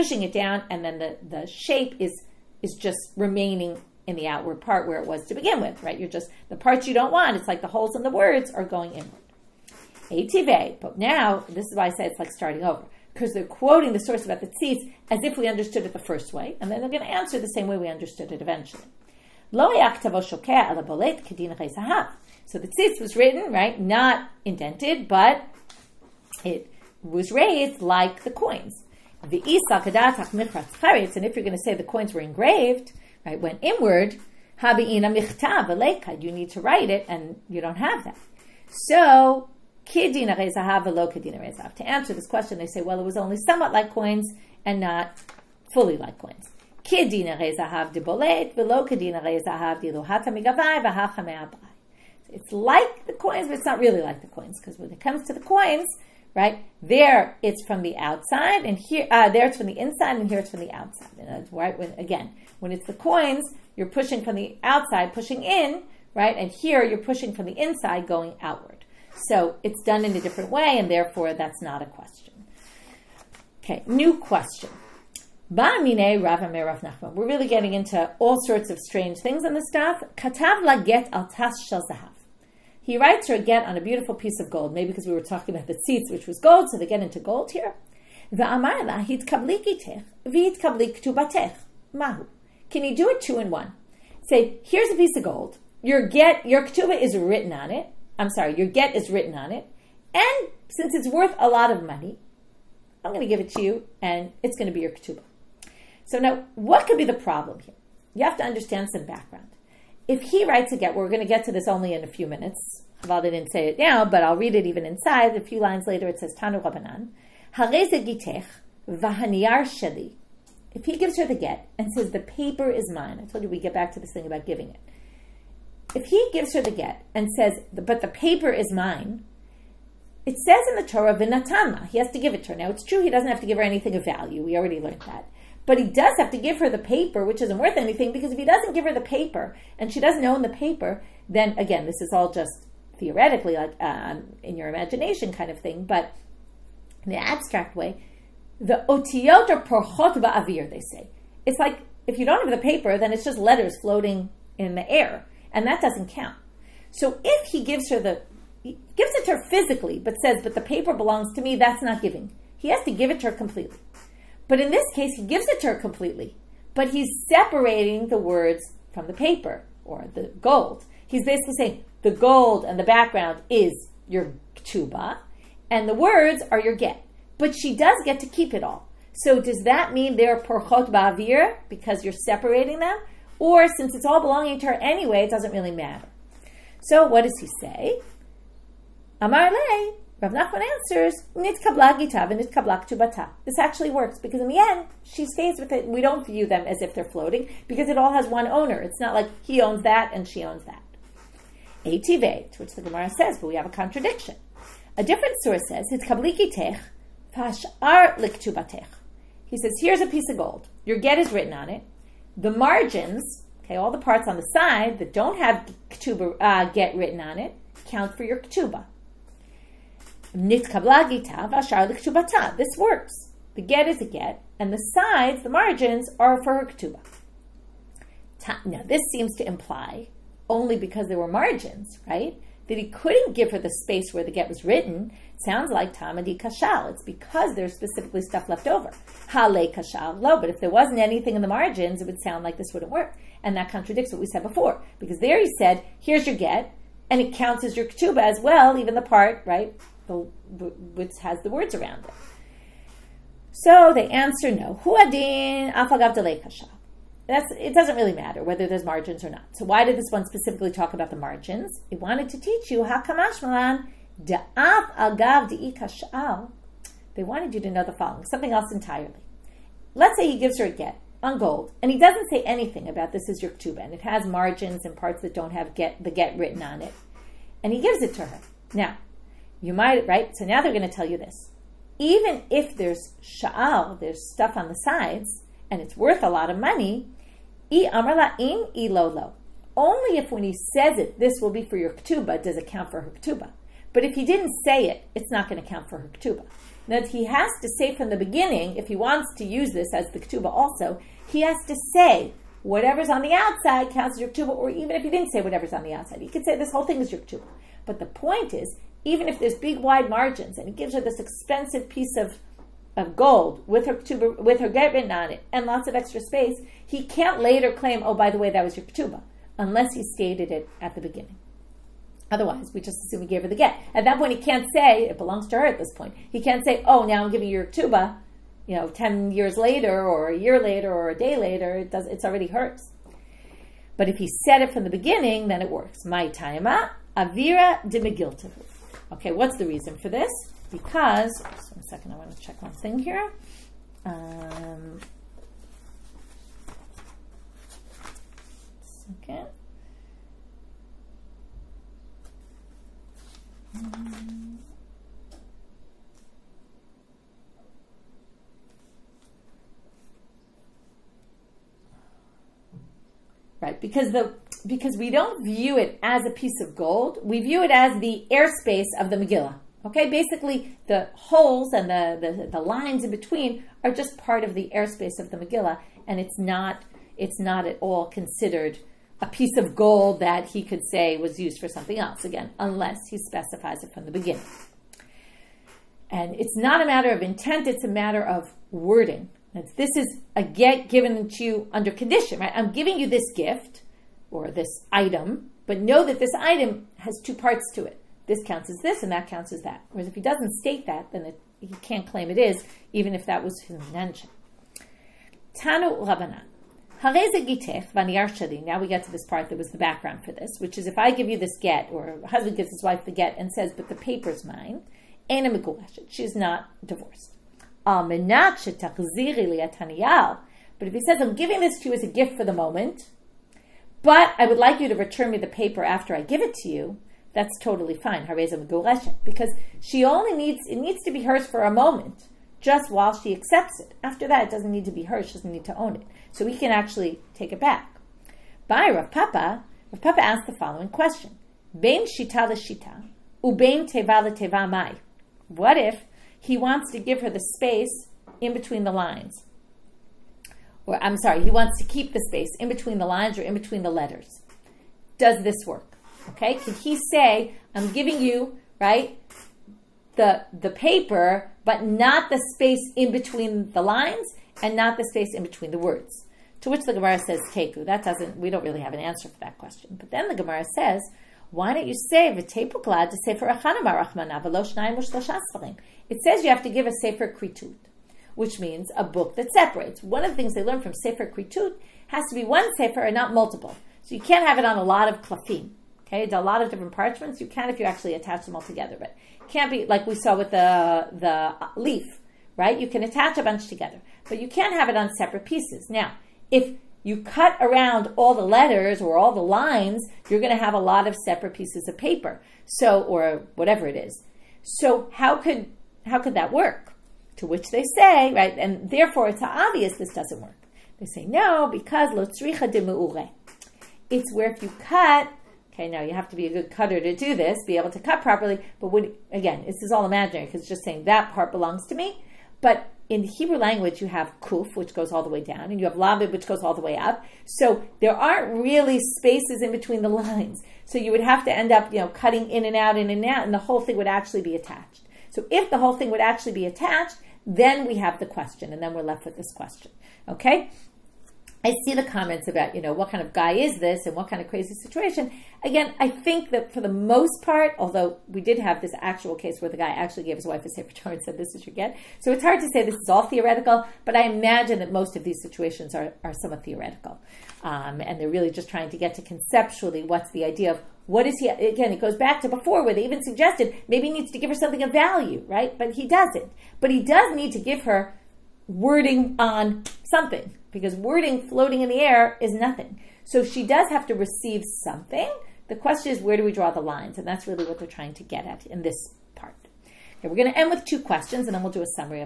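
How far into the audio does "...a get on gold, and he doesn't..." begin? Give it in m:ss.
4:30.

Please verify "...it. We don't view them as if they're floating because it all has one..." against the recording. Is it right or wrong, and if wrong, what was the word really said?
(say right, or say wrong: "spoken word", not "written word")
right.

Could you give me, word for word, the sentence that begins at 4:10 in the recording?
which has the words around it.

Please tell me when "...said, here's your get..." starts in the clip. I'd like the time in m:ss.
4:05.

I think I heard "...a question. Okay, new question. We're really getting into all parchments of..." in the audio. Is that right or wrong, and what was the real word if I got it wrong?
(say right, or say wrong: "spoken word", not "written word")
wrong: "sorts", not "parchments".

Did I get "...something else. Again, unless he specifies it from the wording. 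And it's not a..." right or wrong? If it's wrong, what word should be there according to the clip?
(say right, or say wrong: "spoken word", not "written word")
wrong: "beginning", not "wording".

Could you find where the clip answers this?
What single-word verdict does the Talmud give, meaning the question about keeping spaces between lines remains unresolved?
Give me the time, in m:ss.
7:47.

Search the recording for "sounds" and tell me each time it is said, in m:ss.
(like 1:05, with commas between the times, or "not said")
3:55, 4:02.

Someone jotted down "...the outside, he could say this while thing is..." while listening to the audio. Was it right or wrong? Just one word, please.
wrong.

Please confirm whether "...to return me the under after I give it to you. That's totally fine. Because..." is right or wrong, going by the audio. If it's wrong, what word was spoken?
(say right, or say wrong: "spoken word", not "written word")
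wrong: "paper", not "under".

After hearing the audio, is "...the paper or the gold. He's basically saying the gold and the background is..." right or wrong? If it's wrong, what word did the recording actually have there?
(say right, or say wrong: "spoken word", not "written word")
right.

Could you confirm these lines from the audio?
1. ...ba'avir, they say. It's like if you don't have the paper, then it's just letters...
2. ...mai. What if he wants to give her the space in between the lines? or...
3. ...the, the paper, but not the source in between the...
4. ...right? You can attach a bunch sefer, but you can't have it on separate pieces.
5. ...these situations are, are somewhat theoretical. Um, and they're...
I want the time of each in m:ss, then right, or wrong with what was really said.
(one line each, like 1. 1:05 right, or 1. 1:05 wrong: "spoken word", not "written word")
1. 2:30 right
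2. 7:24 right
3. 7:40 wrong: "space", not "source"
4. 8:12 wrong: "together", not "sefer"
5. 9:15 right.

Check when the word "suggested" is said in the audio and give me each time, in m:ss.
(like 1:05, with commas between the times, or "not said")
9:23.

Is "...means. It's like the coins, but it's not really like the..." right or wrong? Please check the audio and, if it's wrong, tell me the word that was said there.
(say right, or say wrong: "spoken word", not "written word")
wrong: "coins", not "means".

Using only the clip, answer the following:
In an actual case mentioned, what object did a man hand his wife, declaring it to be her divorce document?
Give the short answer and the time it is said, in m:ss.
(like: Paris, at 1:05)
A sefer Torah, at 9:10.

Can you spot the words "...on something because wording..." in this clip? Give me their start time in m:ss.
9:29.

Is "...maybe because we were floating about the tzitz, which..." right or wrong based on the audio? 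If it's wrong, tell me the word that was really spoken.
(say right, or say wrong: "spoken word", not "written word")
wrong: "talking", not "floating".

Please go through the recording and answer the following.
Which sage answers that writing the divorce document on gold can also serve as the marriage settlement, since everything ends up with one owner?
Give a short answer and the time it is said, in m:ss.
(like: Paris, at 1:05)
Rav Nachman, at 3:10.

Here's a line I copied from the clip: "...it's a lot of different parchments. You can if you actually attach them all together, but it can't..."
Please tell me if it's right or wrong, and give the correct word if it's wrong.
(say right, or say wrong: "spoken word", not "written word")
right.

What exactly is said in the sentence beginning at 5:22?
Otherwise, we just assume he gave her the get.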